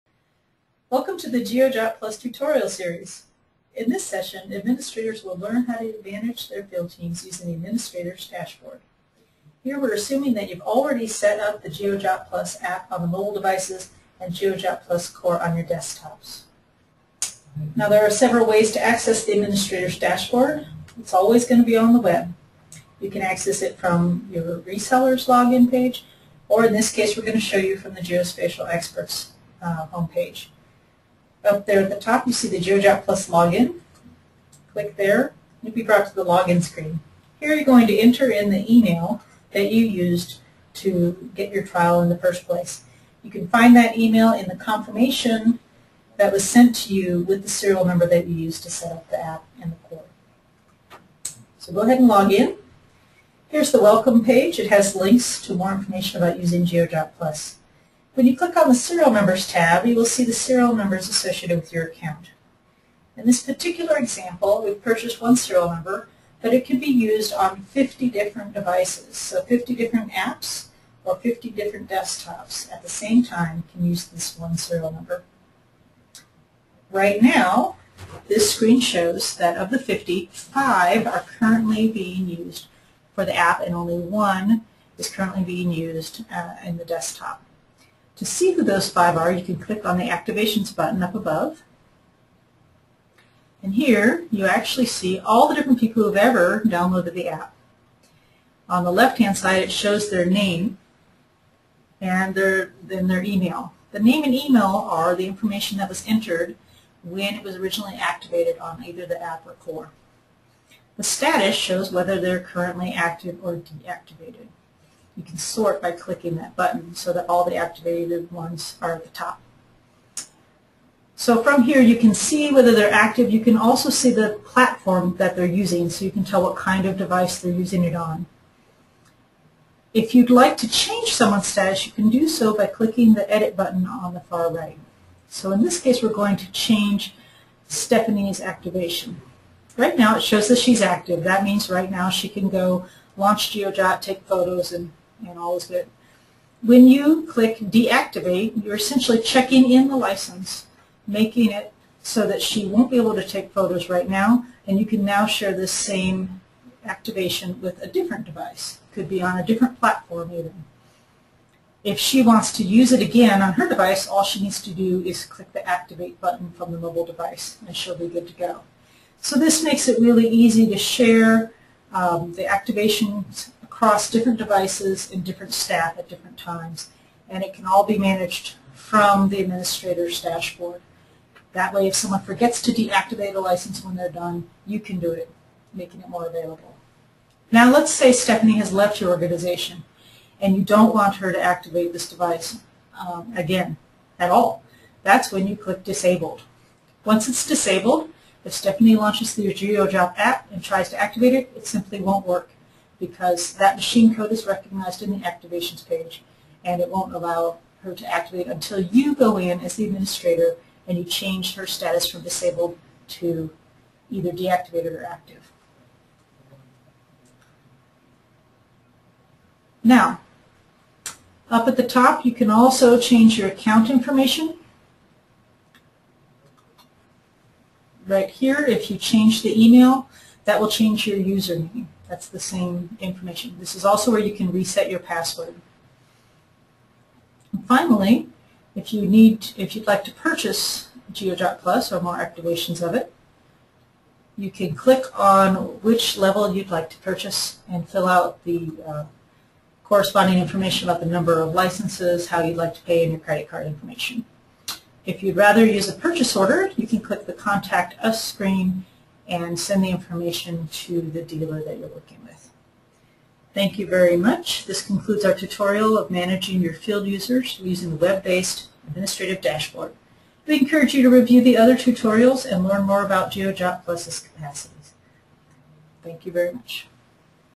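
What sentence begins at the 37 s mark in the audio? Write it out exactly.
Here you're going to enter in the email that you used to get your trial in the first place.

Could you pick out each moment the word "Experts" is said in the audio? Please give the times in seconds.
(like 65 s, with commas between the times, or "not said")
28 s.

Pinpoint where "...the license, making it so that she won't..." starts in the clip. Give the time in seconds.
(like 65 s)
149 s.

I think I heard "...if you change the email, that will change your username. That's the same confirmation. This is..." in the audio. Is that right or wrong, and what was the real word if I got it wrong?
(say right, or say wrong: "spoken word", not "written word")
wrong: "information", not "confirmation".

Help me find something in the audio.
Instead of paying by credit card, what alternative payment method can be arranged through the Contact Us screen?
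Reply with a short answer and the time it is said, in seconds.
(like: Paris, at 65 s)
Purchase order, at 255 s.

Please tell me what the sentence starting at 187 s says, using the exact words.
Now, let's say Stephanie has left your organization and you don't want her to activate this device um, again at all.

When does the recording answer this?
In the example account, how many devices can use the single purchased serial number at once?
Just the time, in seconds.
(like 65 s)
67 s.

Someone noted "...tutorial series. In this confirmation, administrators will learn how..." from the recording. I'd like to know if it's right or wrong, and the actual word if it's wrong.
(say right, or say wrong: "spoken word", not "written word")
wrong: "session", not "confirmation".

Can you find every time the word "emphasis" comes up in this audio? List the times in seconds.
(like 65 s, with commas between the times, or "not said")
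not said.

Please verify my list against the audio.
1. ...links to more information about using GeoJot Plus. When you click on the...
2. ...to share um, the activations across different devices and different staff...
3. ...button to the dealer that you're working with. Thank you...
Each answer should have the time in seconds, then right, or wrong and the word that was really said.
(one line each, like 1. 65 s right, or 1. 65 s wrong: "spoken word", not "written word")
1. 54 s right
2. 170 s right
3. 259 s wrong: "information", not "button".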